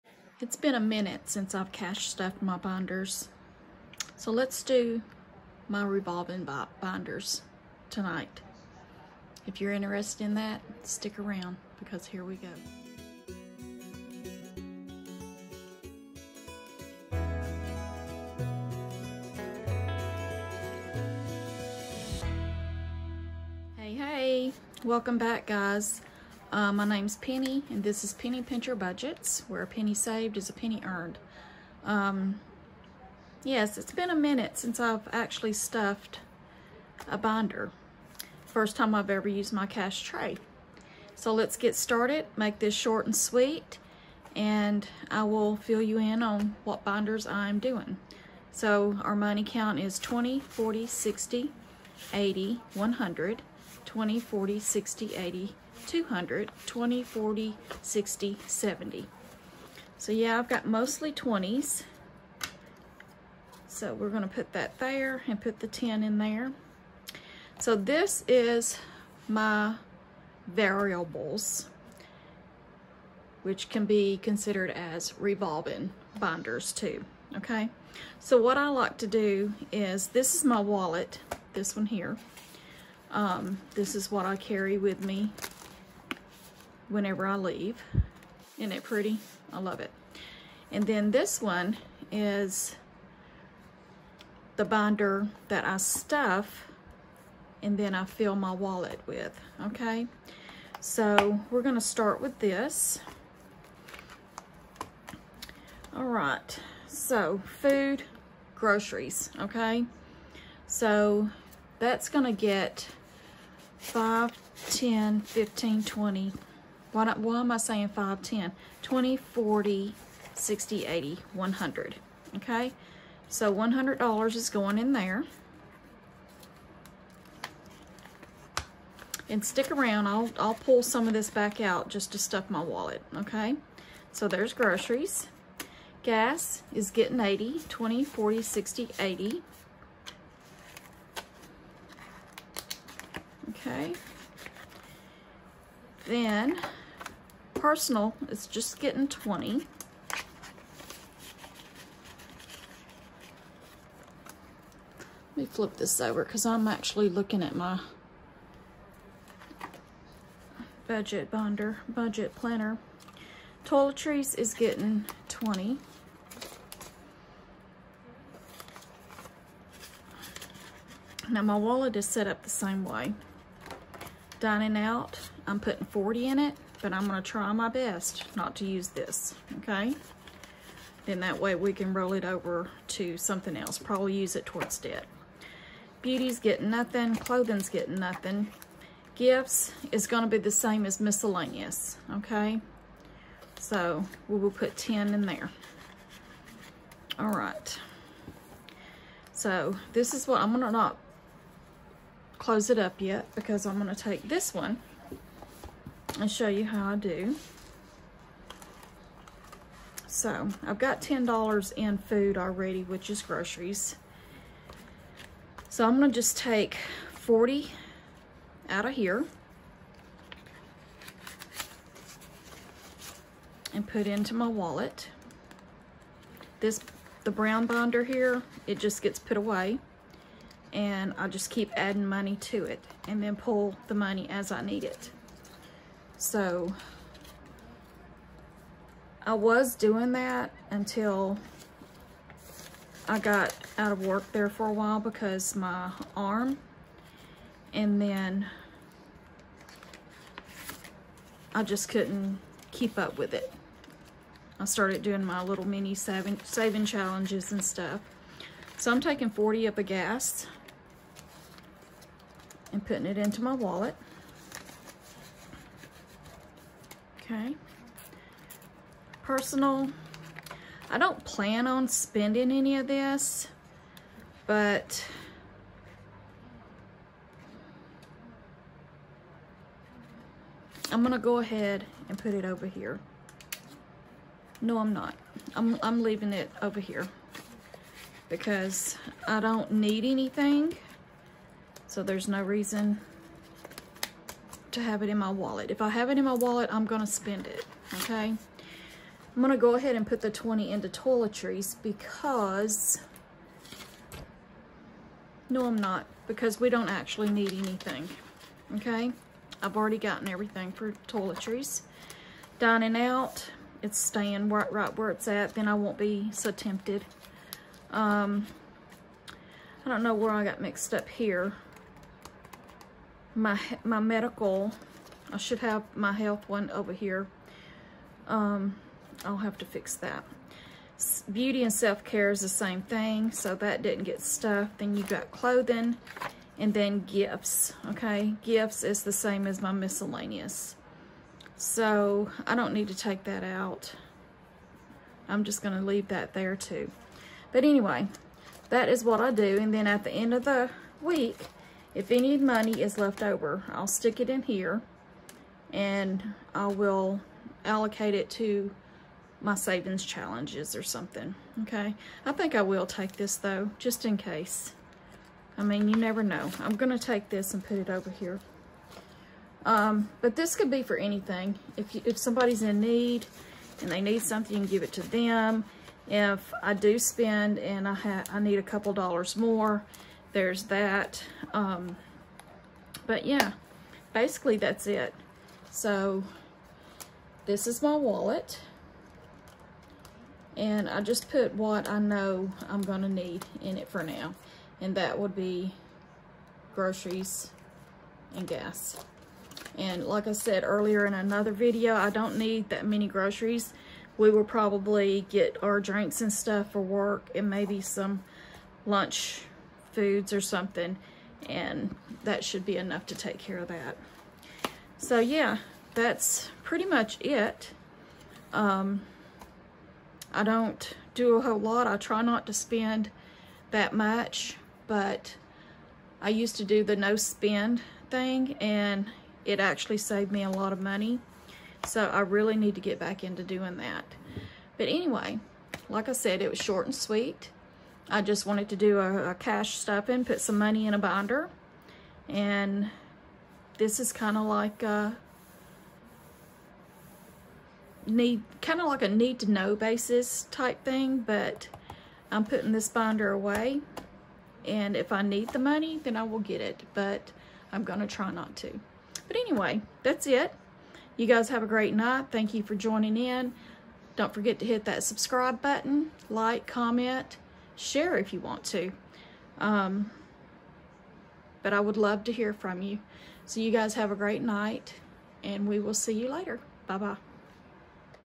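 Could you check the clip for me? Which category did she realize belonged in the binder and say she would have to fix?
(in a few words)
medical.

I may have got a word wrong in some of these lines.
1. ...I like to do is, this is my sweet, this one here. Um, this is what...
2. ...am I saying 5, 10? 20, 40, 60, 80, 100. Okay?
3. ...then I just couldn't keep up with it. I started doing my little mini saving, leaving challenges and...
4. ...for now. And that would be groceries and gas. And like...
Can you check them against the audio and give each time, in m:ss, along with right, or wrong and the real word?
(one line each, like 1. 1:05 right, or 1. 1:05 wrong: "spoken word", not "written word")
1. 1:18 wrong: "wallet", not "sweet"
2. 1:57 right
3. 4:07 wrong: "saving", not "leaving"
4. 6:33 right.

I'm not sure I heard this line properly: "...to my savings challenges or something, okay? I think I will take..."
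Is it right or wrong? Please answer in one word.
right.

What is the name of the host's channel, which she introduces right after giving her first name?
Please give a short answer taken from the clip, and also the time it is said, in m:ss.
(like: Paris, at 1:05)
Penny Pincher Budgets, at 0:28.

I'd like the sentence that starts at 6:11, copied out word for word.
If, you, if somebody's in need and they need something, you can give it to them.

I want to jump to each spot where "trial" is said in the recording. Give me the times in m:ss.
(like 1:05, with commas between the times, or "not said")
not said.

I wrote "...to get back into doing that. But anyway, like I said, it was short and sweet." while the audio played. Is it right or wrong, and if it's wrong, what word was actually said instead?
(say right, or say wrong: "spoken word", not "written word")
right.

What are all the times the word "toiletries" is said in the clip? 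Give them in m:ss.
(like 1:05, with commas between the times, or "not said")
2:43, 5:00, 5:11.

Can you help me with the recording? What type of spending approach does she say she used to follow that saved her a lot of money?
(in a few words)
no spend.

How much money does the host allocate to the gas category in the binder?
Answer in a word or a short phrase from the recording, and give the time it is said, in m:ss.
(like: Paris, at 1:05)
$80, at 2:16.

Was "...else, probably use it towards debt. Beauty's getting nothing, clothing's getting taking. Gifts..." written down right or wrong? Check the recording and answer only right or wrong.
wrong.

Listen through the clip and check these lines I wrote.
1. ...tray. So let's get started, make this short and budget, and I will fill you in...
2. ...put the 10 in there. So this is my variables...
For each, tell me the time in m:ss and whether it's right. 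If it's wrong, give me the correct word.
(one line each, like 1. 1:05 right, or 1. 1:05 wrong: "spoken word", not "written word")
1. 0:40 wrong: "sweet", not "budget"
2. 1:05 right.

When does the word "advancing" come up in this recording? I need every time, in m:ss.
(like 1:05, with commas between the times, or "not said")
not said.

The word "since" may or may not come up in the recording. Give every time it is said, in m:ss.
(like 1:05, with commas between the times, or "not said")
0:01, 0:34.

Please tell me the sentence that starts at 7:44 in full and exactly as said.
Don't forget to hit that subscribe button, like, comment, share if you want to.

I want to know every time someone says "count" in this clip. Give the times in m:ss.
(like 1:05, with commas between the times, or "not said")
0:49.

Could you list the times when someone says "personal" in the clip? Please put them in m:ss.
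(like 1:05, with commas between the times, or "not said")
2:27, 4:29.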